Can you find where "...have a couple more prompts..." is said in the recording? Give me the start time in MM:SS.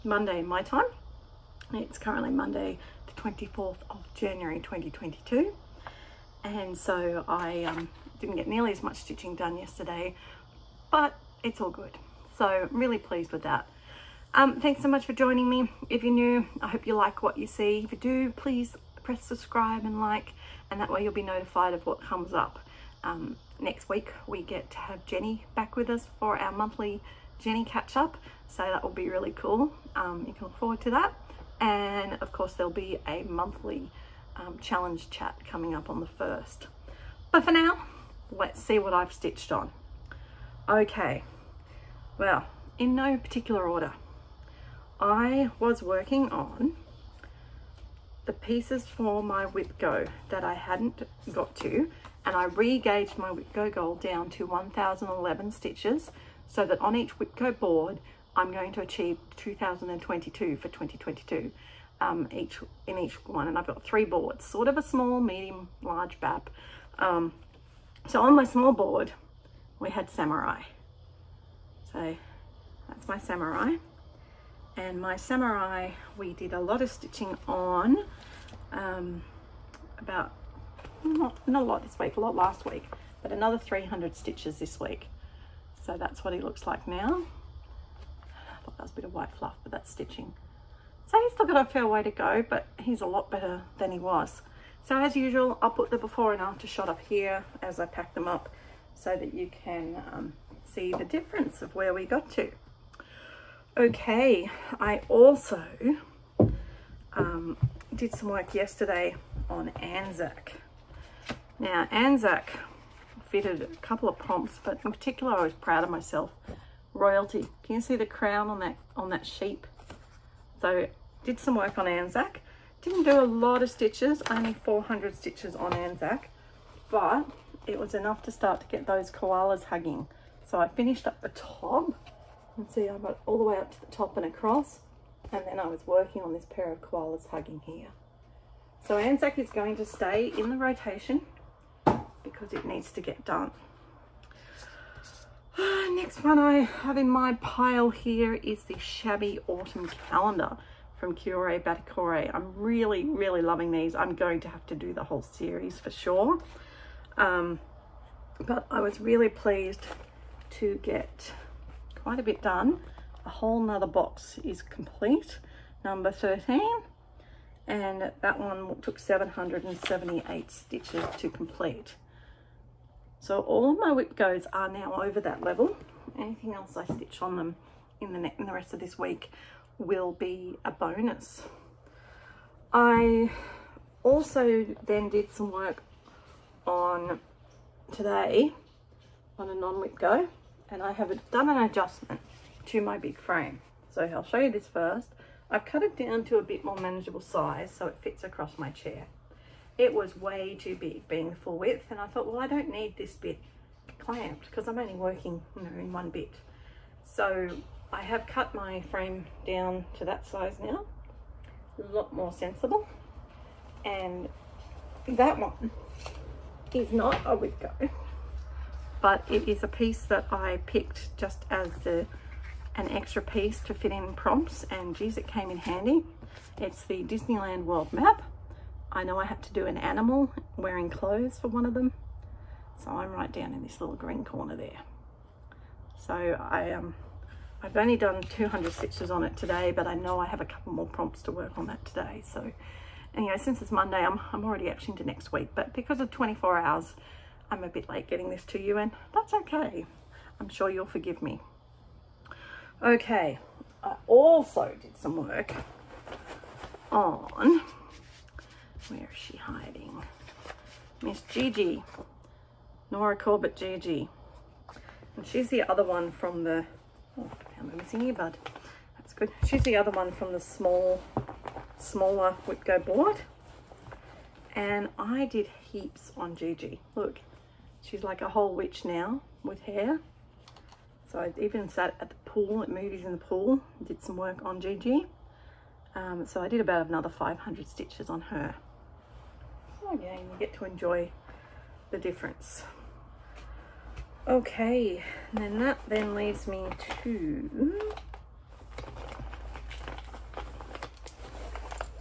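04:00.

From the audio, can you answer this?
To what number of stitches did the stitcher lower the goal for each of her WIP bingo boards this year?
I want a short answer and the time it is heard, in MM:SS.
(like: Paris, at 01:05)
1011, at 00:54.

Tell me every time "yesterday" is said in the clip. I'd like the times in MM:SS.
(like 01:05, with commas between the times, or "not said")
00:09, 01:48.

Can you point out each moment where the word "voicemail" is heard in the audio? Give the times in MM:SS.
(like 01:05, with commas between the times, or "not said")
not said.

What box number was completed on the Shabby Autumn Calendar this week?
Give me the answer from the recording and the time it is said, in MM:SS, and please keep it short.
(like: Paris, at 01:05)
13, at 02:45.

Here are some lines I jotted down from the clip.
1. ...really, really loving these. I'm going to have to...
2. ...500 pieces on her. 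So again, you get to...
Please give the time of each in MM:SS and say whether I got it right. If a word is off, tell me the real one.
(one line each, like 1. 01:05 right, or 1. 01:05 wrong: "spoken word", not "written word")
1. 02:32 right
2. 04:47 wrong: "stitches", not "pieces".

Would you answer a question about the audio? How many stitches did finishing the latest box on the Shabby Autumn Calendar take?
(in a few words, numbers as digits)
778.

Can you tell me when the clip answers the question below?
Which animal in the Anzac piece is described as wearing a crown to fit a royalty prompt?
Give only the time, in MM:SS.
01:59.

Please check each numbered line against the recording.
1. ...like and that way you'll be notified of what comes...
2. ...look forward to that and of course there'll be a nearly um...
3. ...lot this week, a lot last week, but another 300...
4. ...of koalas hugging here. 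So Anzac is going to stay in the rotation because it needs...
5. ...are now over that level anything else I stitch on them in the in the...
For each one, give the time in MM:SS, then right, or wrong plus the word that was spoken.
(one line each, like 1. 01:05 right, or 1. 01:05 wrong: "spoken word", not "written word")
1. 00:19 right
2. 00:30 wrong: "monthly", not "nearly"
3. 01:21 right
4. 02:16 right
5. 02:54 right.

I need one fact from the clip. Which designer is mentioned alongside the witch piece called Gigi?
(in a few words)
Nora Corbett.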